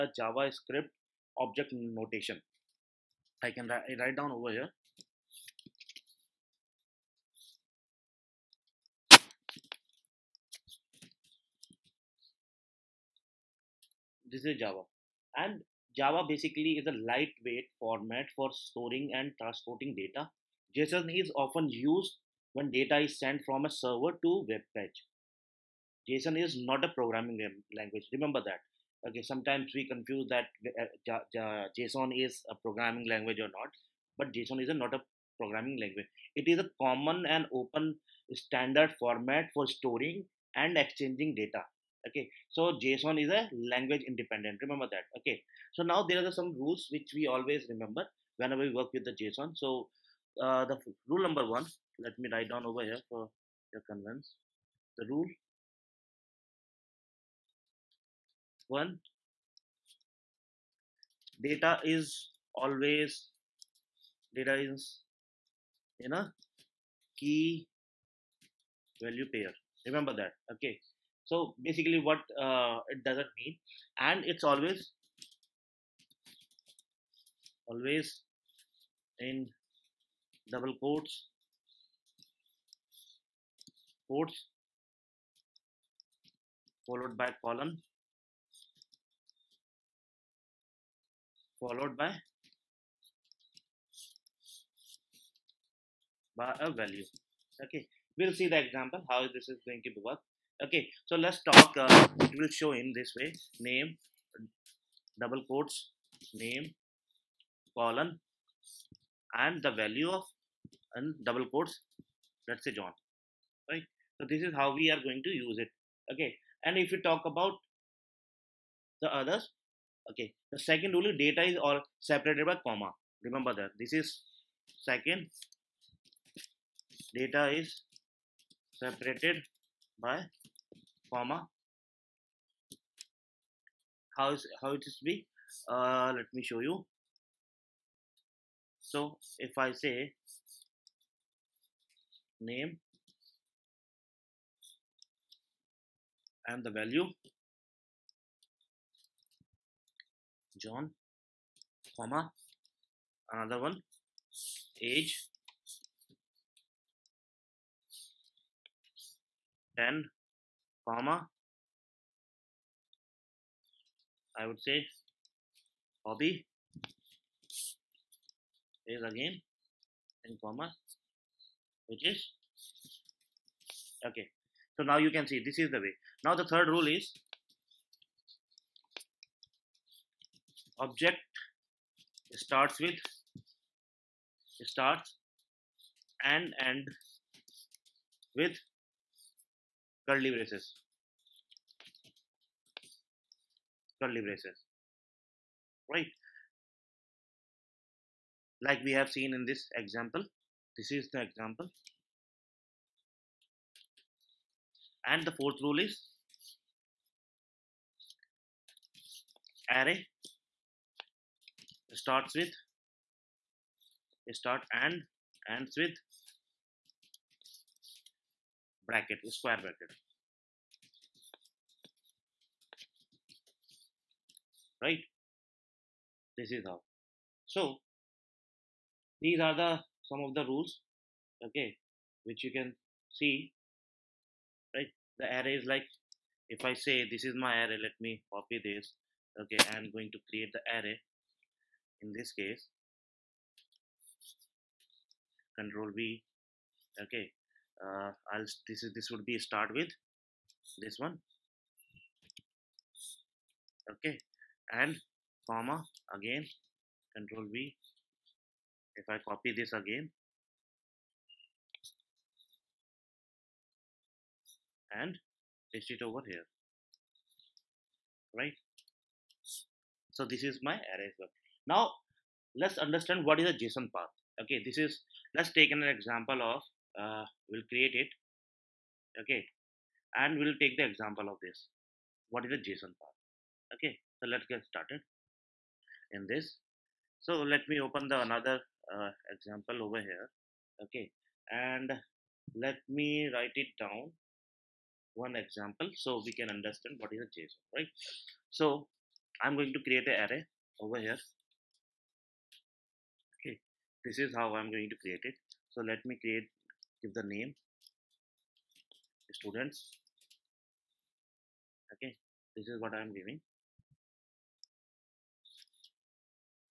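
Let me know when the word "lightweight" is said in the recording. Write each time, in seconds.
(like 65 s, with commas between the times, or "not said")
17 s.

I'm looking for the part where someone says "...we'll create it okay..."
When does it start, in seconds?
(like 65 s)
277 s.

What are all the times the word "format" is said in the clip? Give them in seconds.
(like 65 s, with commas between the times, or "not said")
17 s, 38 s.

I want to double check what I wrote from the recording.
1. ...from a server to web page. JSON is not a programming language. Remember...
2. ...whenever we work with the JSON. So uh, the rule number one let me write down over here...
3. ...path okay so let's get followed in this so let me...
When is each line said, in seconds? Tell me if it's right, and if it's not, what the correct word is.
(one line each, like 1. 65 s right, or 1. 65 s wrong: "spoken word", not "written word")
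1. 23 s right
2. 48 s right
3. 283 s wrong: "started", not "followed".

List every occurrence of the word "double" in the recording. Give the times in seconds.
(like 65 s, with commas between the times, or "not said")
80 s, 105 s, 111 s.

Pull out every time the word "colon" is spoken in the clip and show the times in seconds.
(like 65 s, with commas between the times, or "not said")
87 s, 107 s.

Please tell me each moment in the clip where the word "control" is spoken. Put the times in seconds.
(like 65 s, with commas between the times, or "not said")
245 s, 257 s.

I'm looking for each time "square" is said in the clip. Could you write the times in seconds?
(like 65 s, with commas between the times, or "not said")
219 s.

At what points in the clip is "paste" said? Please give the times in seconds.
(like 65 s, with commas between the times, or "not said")
265 s.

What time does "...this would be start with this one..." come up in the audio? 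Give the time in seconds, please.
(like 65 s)
248 s.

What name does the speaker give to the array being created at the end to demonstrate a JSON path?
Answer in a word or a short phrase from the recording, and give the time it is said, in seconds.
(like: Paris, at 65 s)
students, at 309 s.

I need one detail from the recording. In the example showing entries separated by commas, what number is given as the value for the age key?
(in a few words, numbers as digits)
10.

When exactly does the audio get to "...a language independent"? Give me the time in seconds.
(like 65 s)
43 s.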